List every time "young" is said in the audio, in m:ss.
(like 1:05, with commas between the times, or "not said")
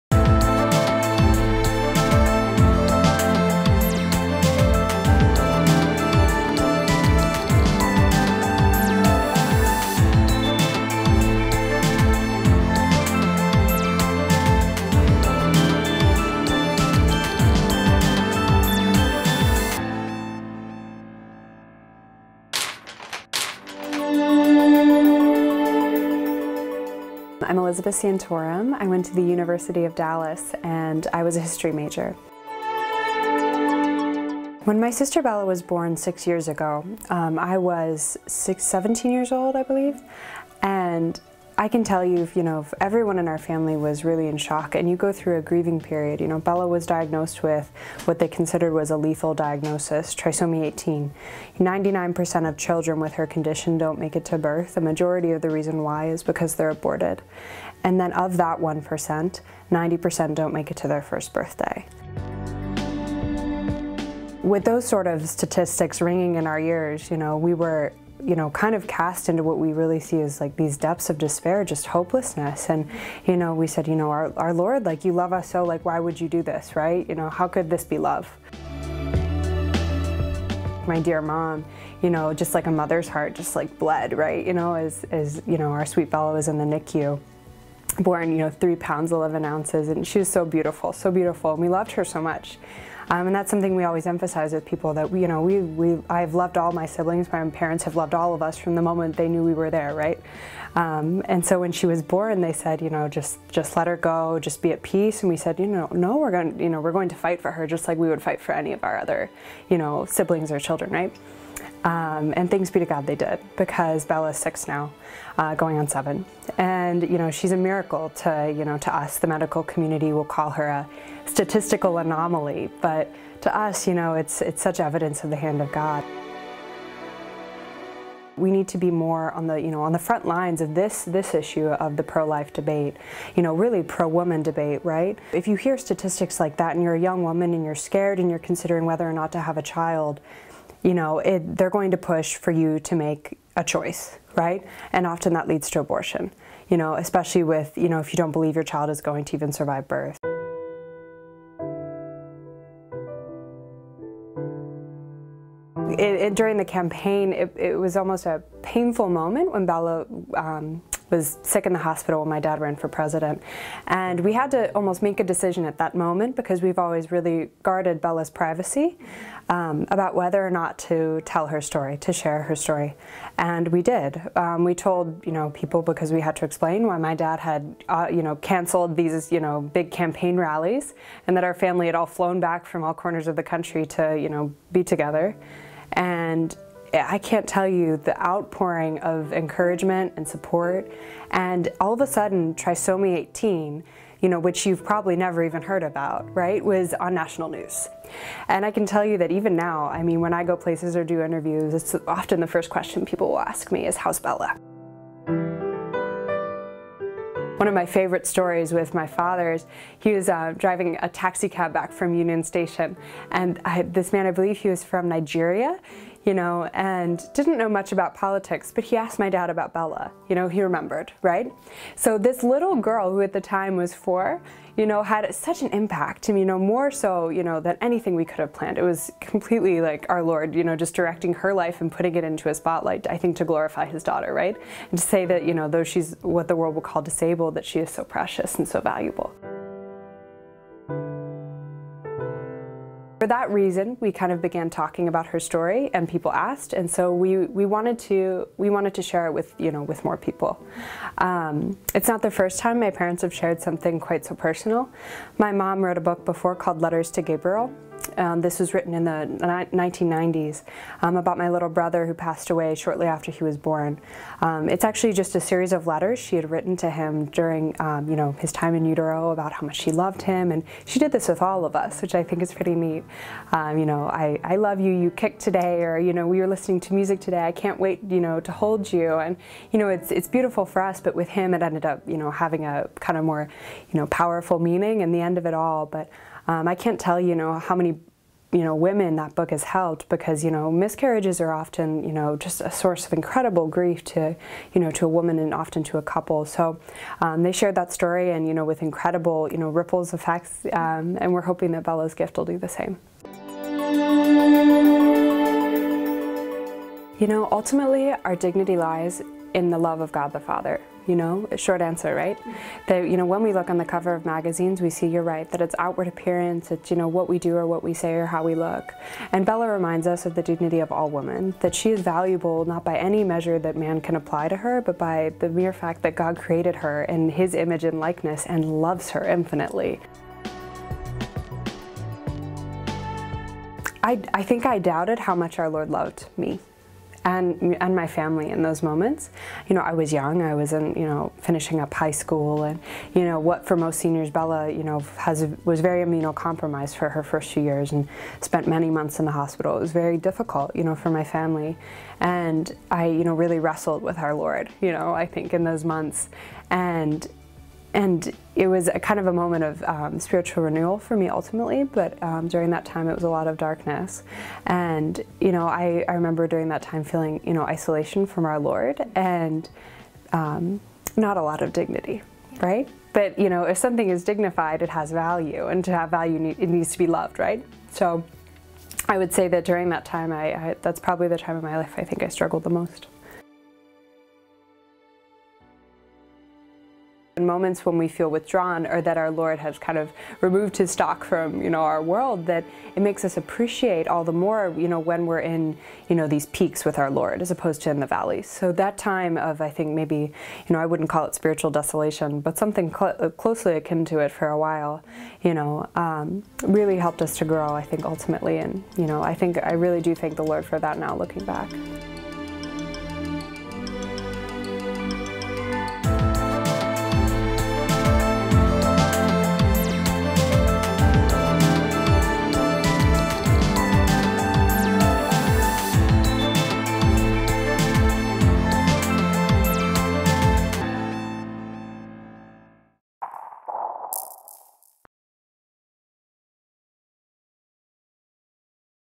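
2:17, 5:40.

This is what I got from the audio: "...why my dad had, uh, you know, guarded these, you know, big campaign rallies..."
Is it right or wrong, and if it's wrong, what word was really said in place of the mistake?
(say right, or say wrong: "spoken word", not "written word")
wrong: "canceled", not "guarded".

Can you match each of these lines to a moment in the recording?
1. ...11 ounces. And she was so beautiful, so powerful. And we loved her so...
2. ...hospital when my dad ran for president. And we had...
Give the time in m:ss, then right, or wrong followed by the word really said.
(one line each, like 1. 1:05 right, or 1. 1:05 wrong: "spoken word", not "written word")
1. 1:29 wrong: "beautiful", not "powerful"
2. 2:41 right.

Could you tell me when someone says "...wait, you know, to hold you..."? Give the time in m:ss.
4:37.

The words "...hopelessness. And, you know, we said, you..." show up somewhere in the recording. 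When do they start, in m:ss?
1:11.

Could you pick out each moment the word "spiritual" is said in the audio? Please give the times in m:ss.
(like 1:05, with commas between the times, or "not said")
6:00, 6:41.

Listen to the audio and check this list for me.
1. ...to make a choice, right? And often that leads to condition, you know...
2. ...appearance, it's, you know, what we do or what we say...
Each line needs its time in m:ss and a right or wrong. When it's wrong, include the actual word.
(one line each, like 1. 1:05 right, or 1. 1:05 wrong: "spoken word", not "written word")
1. 2:22 wrong: "abortion", not "condition"
2. 5:16 right.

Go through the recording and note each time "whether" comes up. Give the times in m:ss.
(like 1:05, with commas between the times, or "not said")
2:18, 2:50.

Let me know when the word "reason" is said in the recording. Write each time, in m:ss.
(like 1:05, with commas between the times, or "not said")
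0:55, 4:03.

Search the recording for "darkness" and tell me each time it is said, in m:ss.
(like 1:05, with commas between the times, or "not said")
6:03.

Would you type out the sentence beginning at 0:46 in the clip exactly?
You know, Bella was diagnosed with what they considered was a lethal diagnosis, trisomy 18.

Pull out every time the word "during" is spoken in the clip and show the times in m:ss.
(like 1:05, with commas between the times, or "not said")
2:36, 4:27, 6:02, 6:06, 6:19.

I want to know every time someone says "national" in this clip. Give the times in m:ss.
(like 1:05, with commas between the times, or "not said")
3:17.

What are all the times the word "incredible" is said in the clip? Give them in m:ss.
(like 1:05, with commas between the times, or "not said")
4:53, 4:58.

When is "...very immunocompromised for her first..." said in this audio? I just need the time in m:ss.
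5:45.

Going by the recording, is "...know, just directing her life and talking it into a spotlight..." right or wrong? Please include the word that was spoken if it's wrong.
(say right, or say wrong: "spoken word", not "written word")
wrong: "putting", not "talking".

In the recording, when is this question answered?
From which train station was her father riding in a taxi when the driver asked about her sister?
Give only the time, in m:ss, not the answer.
3:32.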